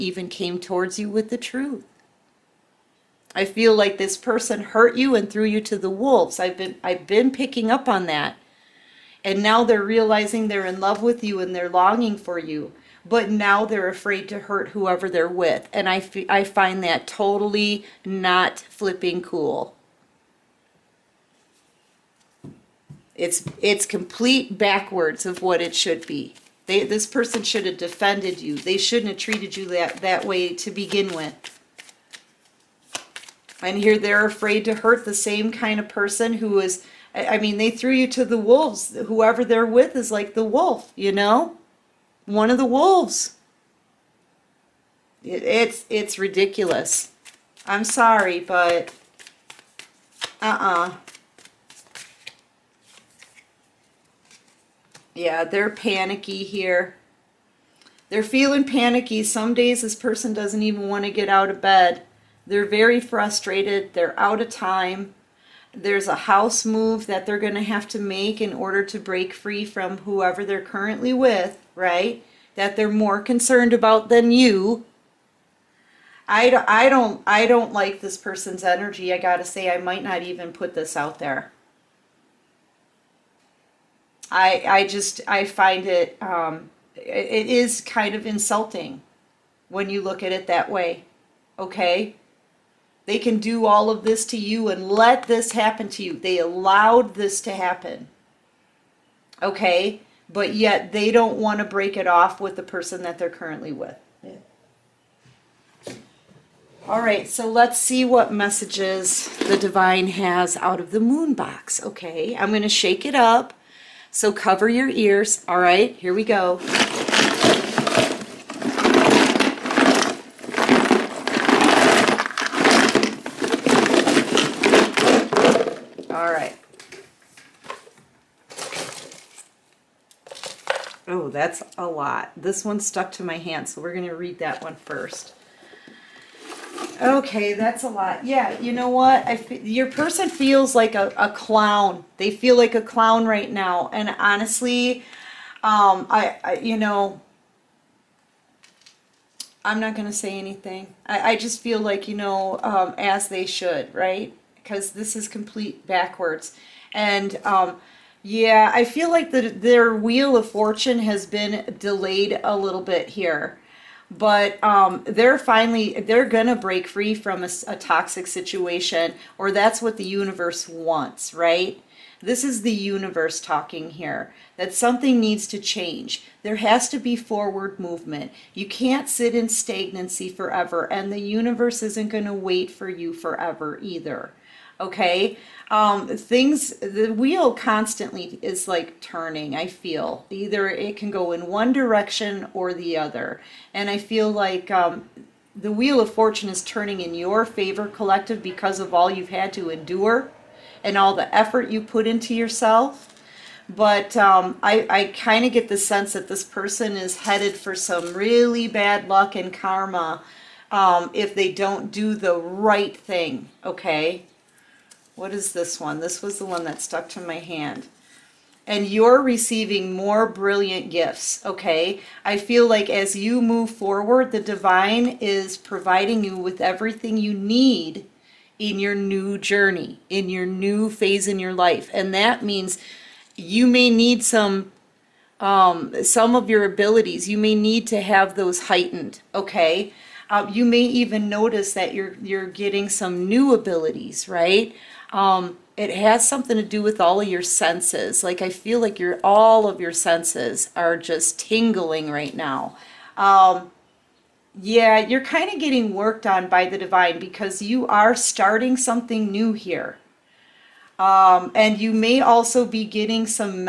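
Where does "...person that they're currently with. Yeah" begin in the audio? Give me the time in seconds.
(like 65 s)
102 s.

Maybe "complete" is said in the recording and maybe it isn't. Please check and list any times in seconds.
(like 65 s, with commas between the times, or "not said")
23 s, 155 s.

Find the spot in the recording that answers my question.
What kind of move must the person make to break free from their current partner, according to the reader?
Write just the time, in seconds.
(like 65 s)
66 s.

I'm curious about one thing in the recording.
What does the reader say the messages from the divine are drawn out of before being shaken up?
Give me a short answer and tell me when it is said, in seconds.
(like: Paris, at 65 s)
Moon box, at 111 s.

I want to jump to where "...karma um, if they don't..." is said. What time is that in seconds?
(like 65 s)
209 s.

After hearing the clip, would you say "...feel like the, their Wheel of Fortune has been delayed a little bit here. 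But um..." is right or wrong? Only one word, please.
right.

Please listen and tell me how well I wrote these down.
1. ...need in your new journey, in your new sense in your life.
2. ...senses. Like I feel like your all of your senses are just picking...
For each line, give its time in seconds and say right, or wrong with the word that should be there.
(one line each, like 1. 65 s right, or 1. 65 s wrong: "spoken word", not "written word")
1. 227 s wrong: "phase", not "sense"
2. 247 s wrong: "tingling", not "picking".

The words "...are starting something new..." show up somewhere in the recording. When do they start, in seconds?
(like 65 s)
257 s.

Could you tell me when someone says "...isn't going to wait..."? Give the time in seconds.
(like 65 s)
181 s.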